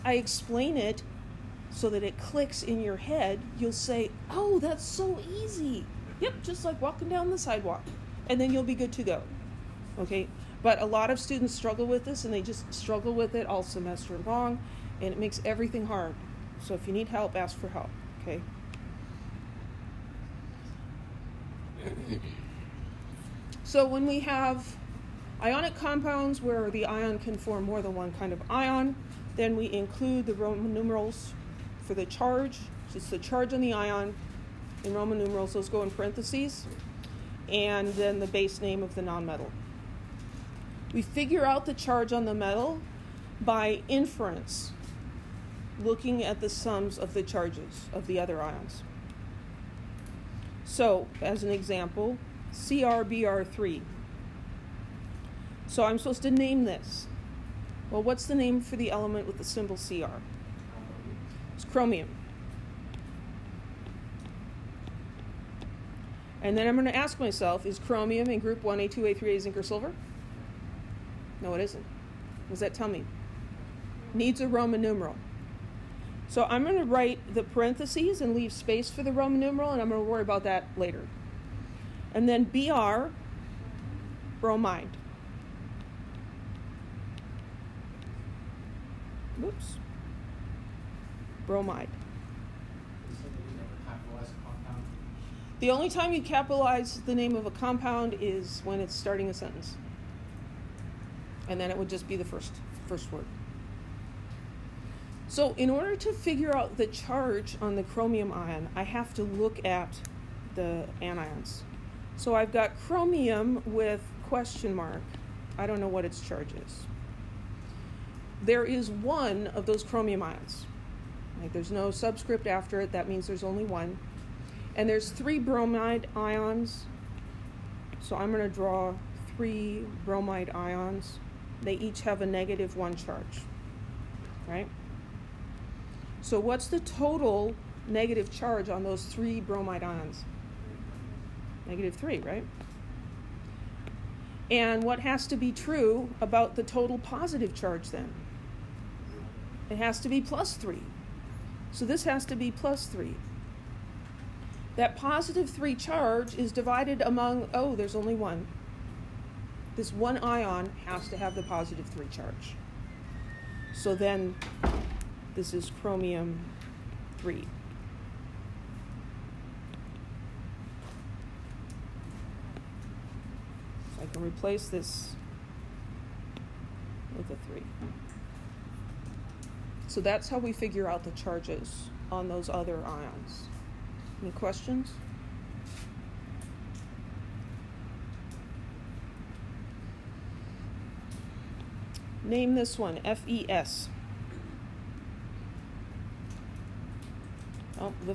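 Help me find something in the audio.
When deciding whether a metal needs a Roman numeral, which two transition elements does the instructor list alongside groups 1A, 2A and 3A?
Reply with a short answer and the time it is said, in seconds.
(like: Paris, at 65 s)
zinc or silver, at 69 s.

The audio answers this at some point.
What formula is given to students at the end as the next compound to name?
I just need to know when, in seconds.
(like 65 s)
193 s.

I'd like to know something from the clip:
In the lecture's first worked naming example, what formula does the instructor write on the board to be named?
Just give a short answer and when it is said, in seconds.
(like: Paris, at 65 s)
CrBr3, at 52 s.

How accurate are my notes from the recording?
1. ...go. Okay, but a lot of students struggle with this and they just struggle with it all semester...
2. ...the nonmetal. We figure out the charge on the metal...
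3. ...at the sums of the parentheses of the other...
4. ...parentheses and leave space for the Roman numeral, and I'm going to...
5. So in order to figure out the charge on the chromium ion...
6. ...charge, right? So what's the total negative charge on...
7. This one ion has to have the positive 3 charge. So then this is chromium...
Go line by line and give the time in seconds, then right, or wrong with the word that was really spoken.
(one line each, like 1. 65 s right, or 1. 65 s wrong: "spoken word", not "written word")
1. 9 s right
2. 38 s right
3. 46 s wrong: "charges", not "parentheses"
4. 77 s right
5. 105 s right
6. 132 s right
7. 159 s right.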